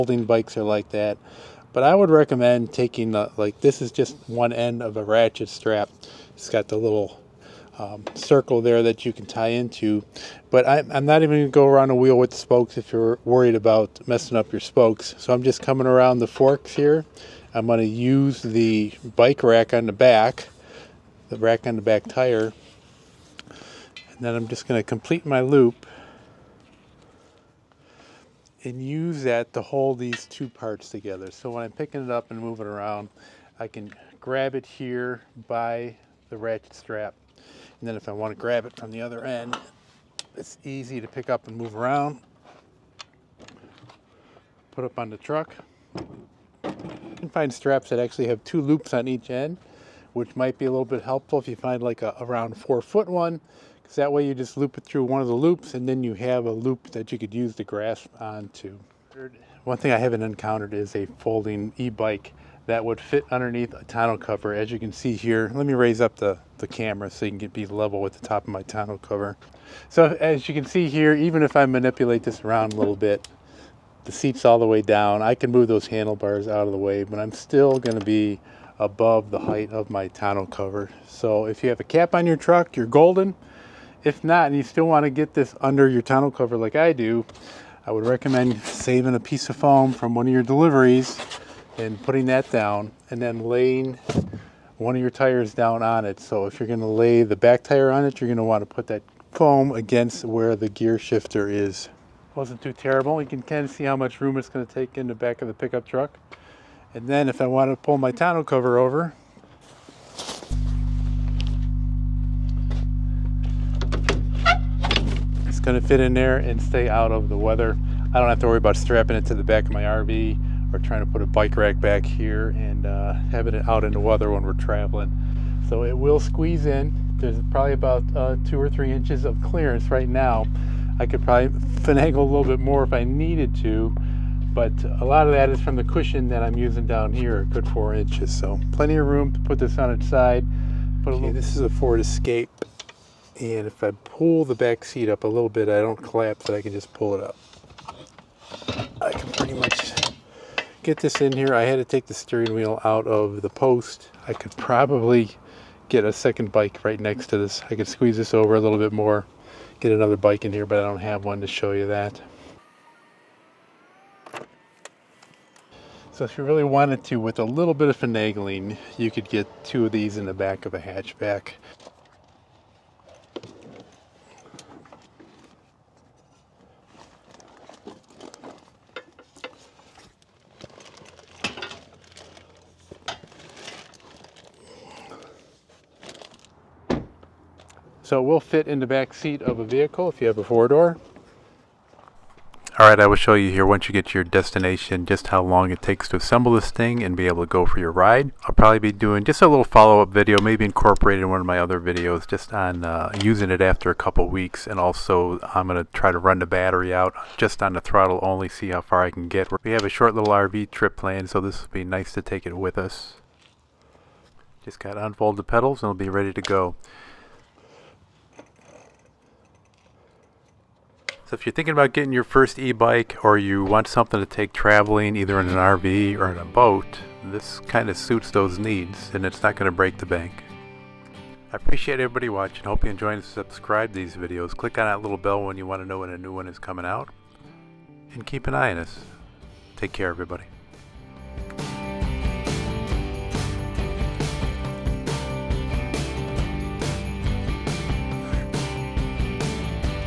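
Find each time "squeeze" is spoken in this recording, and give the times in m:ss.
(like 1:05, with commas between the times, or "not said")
2:06, 2:37.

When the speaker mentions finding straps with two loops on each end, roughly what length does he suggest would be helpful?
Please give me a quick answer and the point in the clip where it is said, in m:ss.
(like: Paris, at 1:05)
around 4 feet, at 0:52.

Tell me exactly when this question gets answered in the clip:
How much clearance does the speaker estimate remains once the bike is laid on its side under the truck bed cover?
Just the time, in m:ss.
2:08.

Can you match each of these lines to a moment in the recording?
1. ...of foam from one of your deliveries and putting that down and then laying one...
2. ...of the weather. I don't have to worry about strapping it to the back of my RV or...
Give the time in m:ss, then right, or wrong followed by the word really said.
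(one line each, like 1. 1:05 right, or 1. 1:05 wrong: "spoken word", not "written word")
1. 1:29 right
2. 1:57 right.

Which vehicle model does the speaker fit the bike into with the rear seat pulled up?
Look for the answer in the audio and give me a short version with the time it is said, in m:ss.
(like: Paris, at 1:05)
Ford Escape, at 2:21.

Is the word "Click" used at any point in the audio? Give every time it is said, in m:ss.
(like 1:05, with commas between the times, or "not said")
3:54.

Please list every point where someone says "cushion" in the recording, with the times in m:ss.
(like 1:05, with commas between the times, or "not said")
2:15.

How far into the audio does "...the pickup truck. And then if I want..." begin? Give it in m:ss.
1:45.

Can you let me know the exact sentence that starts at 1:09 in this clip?
So as you can see here, even if I manipulate this around a little bit, the seat's all the way down.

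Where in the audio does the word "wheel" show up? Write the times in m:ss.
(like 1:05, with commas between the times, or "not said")
0:11, 2:32.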